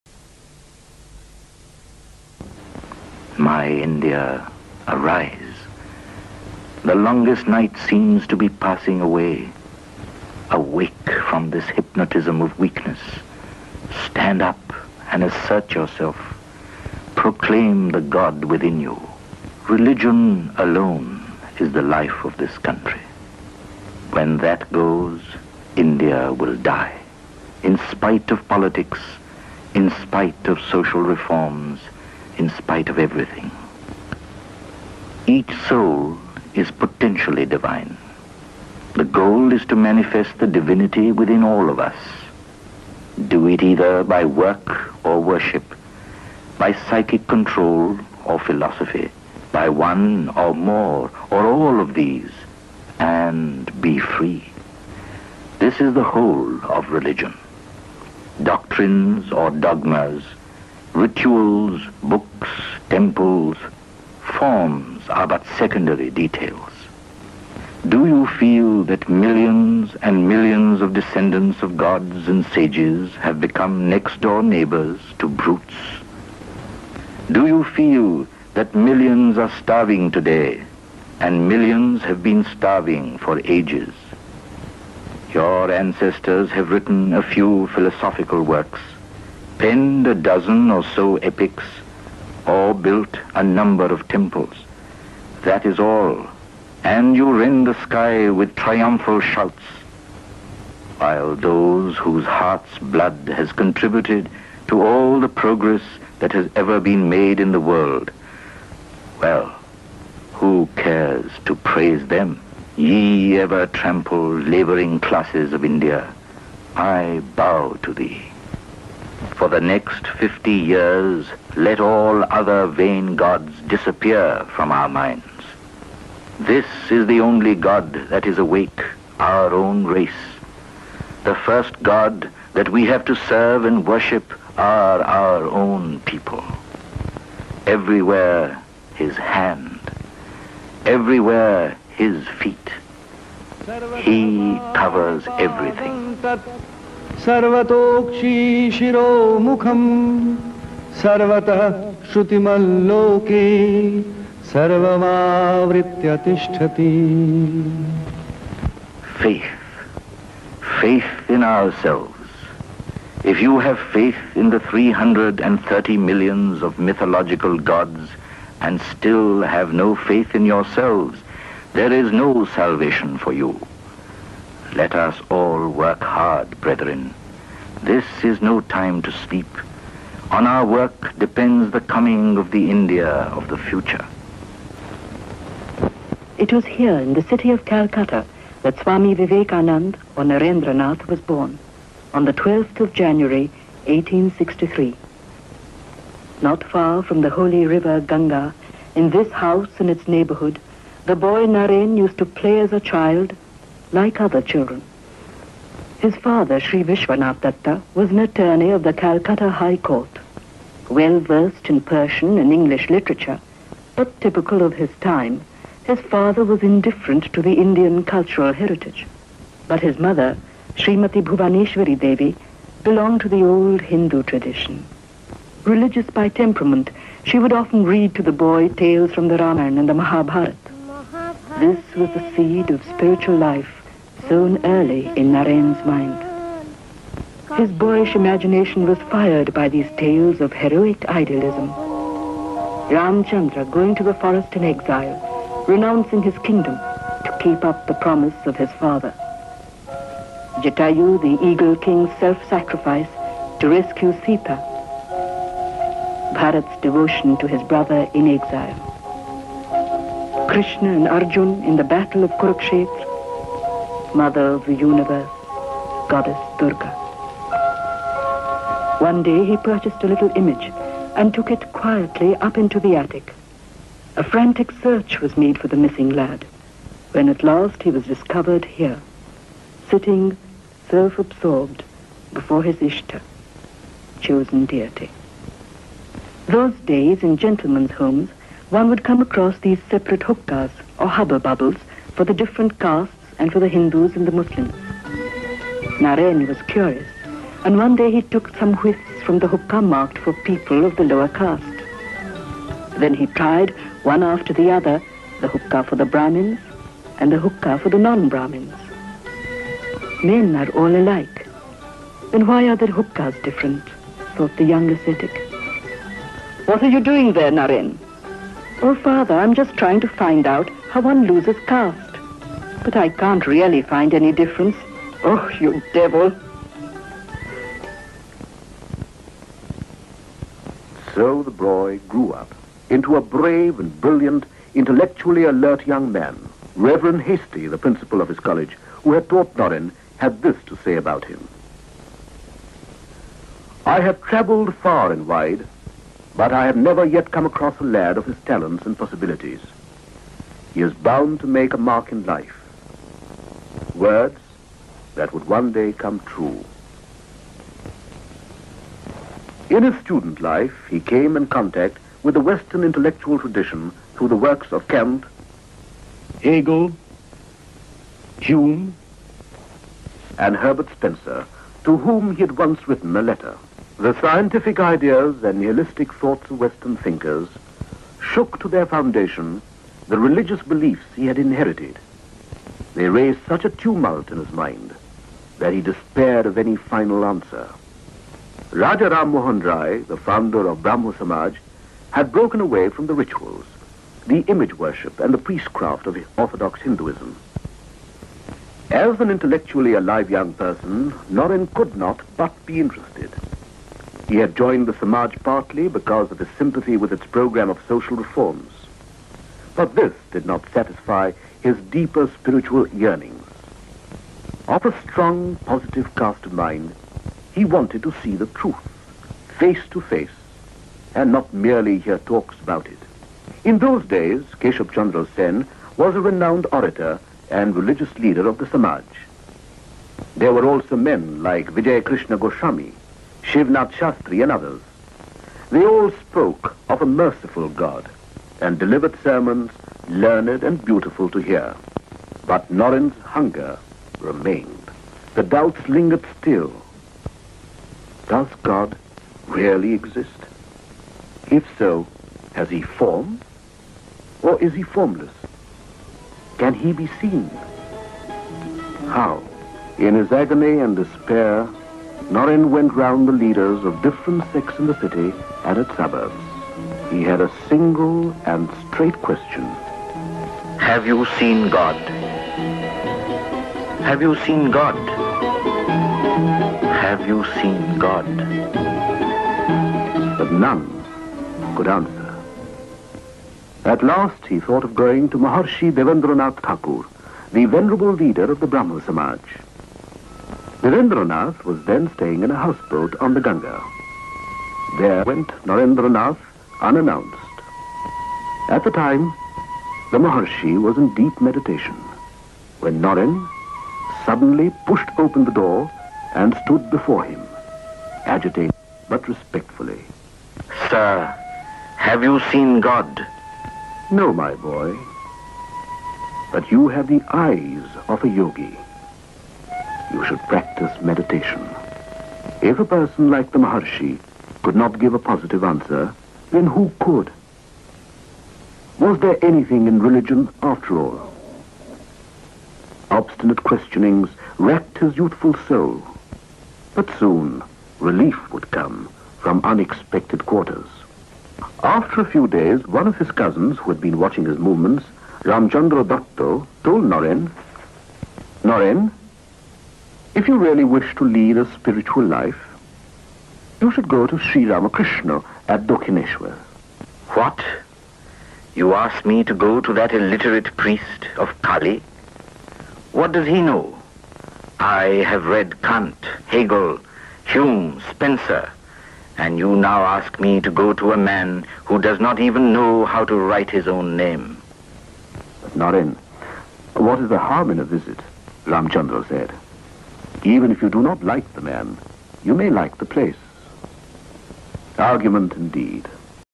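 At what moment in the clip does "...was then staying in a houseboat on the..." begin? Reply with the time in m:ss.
8:11.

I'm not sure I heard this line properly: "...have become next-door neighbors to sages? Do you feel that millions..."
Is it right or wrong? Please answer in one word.
wrong.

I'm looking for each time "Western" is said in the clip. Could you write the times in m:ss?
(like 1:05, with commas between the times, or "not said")
6:02, 6:16.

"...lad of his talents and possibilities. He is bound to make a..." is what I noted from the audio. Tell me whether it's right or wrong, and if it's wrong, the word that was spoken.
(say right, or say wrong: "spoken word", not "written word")
right.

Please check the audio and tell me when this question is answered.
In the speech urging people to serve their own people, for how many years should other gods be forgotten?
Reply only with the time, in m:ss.
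2:00.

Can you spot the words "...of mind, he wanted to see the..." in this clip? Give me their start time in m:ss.
6:56.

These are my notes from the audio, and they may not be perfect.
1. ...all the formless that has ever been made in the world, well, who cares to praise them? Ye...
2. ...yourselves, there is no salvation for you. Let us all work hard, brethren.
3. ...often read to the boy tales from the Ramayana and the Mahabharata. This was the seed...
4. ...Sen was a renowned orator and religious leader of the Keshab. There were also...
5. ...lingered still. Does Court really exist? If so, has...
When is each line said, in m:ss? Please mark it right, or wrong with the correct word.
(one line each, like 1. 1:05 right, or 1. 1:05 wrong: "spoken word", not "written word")
1. 1:44 wrong: "progress", not "formless"
2. 2:50 right
3. 3:47 right
4. 7:05 wrong: "Samaj", not "Keshab"
5. 7:25 wrong: "God", not "Court".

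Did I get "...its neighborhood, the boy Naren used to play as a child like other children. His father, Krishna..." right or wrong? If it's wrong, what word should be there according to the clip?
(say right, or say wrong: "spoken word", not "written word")
wrong: "Sri", not "Krishna".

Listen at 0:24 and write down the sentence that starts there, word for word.
When that goes, India will die.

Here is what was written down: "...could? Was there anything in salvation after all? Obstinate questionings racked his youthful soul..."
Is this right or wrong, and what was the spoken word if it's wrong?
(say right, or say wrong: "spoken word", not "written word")
wrong: "religion", not "salvation".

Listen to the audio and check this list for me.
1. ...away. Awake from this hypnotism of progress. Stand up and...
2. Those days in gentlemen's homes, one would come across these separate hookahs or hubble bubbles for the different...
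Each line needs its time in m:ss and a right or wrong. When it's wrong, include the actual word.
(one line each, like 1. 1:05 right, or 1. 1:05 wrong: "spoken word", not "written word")
1. 0:09 wrong: "weakness", not "progress"
2. 4:46 right.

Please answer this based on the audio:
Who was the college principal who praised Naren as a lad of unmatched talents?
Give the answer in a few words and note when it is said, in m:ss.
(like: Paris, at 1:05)
Reverend Hastie, at 5:36.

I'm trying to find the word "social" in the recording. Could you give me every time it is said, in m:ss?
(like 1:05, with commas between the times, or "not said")
0:30, 6:47.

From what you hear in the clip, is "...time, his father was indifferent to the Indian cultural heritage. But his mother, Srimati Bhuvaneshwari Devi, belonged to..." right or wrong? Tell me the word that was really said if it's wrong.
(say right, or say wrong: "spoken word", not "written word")
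right.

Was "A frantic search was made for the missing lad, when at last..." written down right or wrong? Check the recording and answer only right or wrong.
right.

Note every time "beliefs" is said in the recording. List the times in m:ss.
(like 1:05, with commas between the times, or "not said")
6:20.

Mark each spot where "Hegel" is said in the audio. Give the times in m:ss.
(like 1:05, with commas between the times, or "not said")
6:06, 9:26.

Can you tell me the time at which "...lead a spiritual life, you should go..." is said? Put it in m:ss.
9:11.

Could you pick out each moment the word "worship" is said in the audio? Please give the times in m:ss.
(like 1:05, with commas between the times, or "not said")
0:45, 2:13, 6:34.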